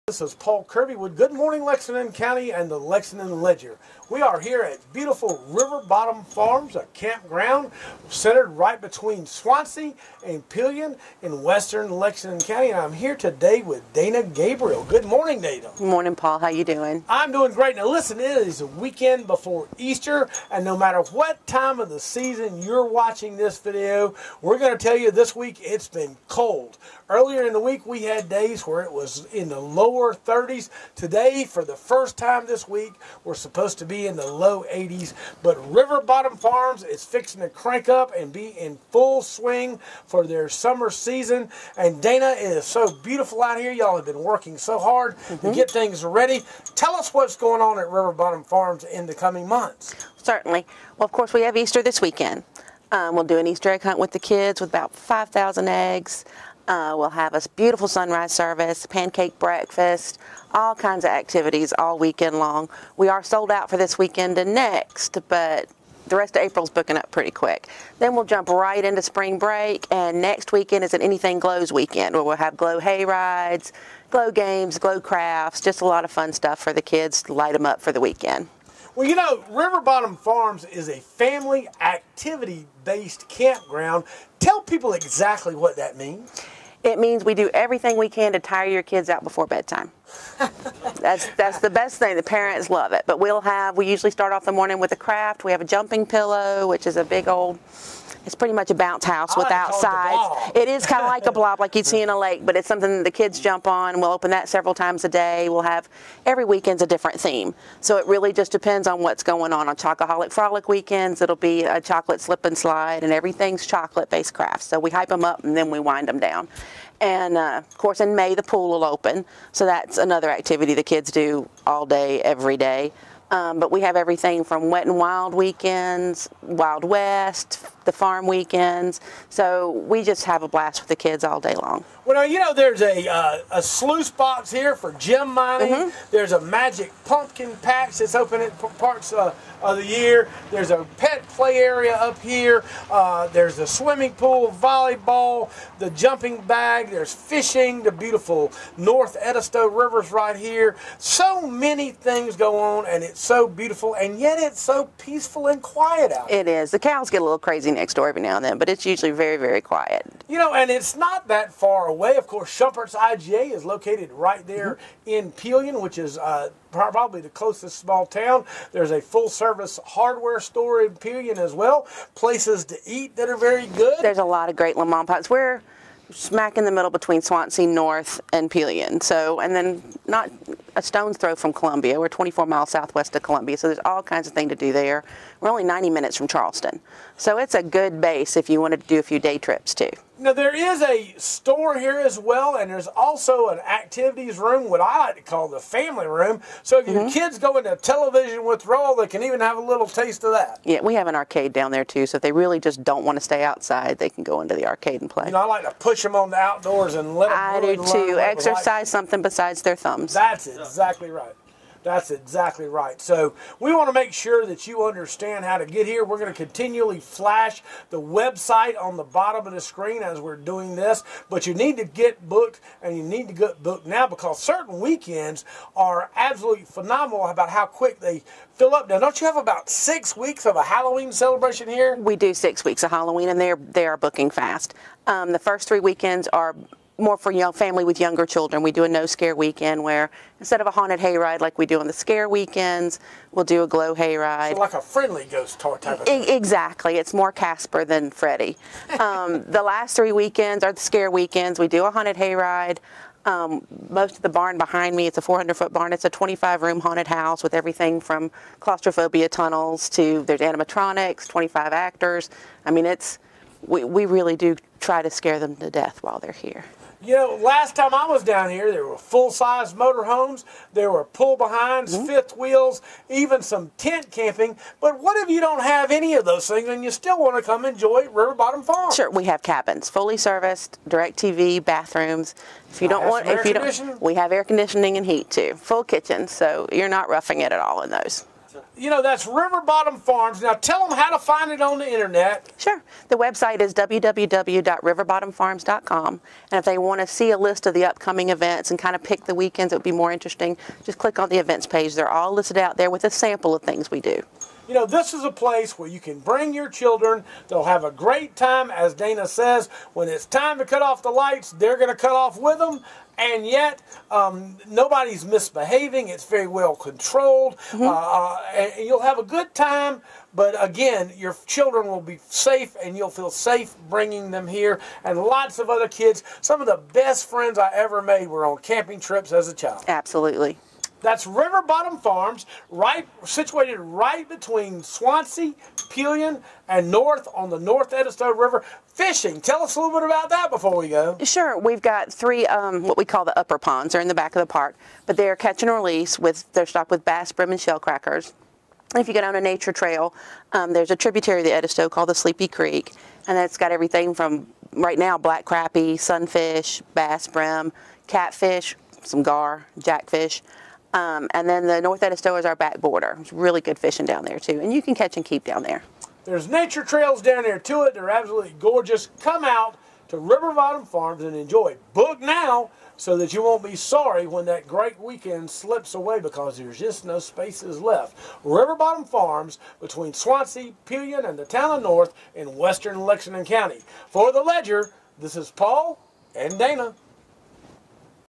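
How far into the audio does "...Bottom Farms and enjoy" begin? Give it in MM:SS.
06:10.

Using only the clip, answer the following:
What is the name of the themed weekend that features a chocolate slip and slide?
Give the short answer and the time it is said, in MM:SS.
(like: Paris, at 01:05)
Chocoholic Frolic, at 01:49.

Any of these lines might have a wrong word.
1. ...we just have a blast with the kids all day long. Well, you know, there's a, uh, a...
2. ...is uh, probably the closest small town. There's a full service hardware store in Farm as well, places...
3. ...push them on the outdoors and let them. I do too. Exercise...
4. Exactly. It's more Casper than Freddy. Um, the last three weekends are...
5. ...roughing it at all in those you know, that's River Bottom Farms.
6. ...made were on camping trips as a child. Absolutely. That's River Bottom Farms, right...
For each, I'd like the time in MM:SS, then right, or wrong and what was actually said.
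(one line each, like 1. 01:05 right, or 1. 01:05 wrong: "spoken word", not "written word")
1. 02:09 right
2. 02:45 wrong: "Pelion", not "Farm"
3. 03:25 right
4. 04:06 right
5. 04:47 right
6. 05:28 right.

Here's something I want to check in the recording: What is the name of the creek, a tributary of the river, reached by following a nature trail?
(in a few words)
Sleepy Creek.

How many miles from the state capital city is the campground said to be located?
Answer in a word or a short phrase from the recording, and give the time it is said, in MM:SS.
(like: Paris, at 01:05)
24, at 03:02.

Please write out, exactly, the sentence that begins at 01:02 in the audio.
We are sold out for this weekend and next, but the rest of April's booking up pretty quick.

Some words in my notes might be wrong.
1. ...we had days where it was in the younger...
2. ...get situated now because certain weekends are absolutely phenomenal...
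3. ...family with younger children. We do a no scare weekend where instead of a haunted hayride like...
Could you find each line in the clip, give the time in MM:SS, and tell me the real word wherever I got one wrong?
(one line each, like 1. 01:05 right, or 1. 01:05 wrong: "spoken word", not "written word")
1. 00:27 wrong: "lower", not "younger"
2. 03:43 wrong: "booked", not "situated"
3. 03:57 right.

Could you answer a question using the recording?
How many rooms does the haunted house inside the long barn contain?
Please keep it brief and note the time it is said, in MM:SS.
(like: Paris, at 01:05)
25, at 04:16.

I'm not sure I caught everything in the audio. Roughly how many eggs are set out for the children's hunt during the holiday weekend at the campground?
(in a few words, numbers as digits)
5,000.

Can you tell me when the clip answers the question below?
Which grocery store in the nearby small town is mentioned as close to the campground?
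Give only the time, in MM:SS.
02:42.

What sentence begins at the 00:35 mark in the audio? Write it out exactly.
But River Bottom Farms is fixing to crank up and be in full swing for their summer season.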